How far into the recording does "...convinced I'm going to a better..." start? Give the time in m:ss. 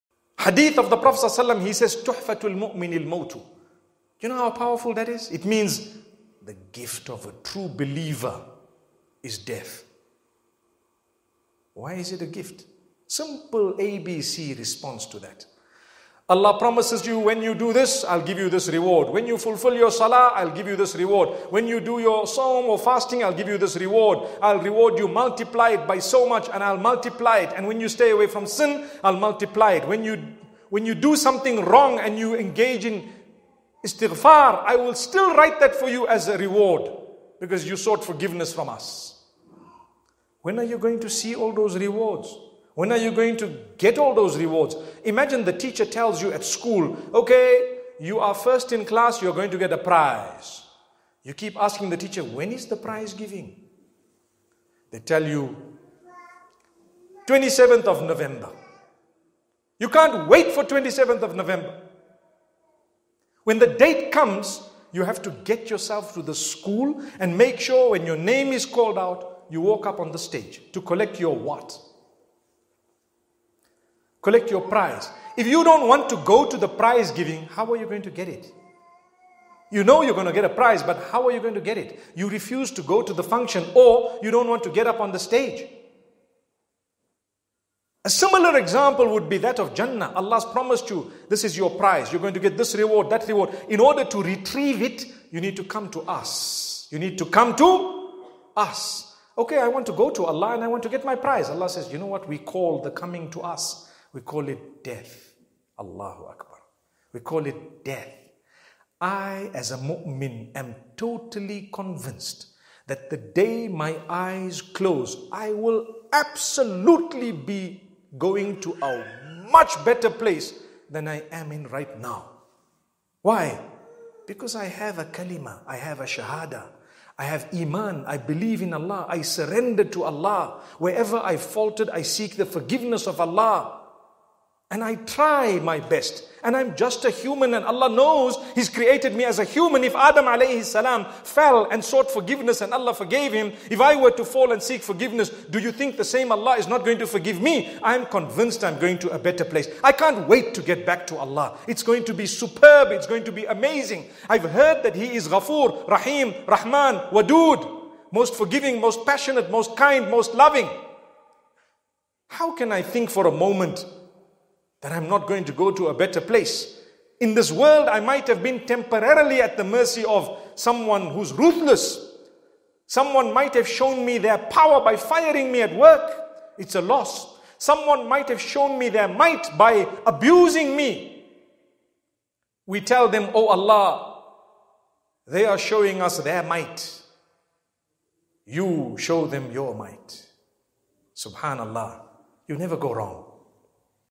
2:28.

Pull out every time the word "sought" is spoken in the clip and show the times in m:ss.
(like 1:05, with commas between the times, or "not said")
0:37, 2:21.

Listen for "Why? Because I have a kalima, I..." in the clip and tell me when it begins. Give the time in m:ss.
2:03.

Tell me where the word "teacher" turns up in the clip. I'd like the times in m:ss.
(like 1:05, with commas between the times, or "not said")
0:45, 0:51.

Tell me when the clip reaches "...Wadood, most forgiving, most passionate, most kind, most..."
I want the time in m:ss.
2:37.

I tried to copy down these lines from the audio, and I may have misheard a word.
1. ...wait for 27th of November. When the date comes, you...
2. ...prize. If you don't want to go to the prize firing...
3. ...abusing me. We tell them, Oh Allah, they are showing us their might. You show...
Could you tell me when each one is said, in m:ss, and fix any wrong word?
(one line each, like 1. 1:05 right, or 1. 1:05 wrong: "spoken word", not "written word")
1. 1:00 right
2. 1:14 wrong: "giving", not "firing"
3. 3:00 right.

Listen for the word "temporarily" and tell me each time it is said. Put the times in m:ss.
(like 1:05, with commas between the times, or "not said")
2:48.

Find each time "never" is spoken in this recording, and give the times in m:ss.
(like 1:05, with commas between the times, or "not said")
3:12.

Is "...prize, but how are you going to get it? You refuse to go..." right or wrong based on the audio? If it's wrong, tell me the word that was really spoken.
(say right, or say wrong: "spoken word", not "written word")
right.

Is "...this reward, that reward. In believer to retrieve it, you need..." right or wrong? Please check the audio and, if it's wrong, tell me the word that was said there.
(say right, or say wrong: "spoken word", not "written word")
wrong: "order", not "believer".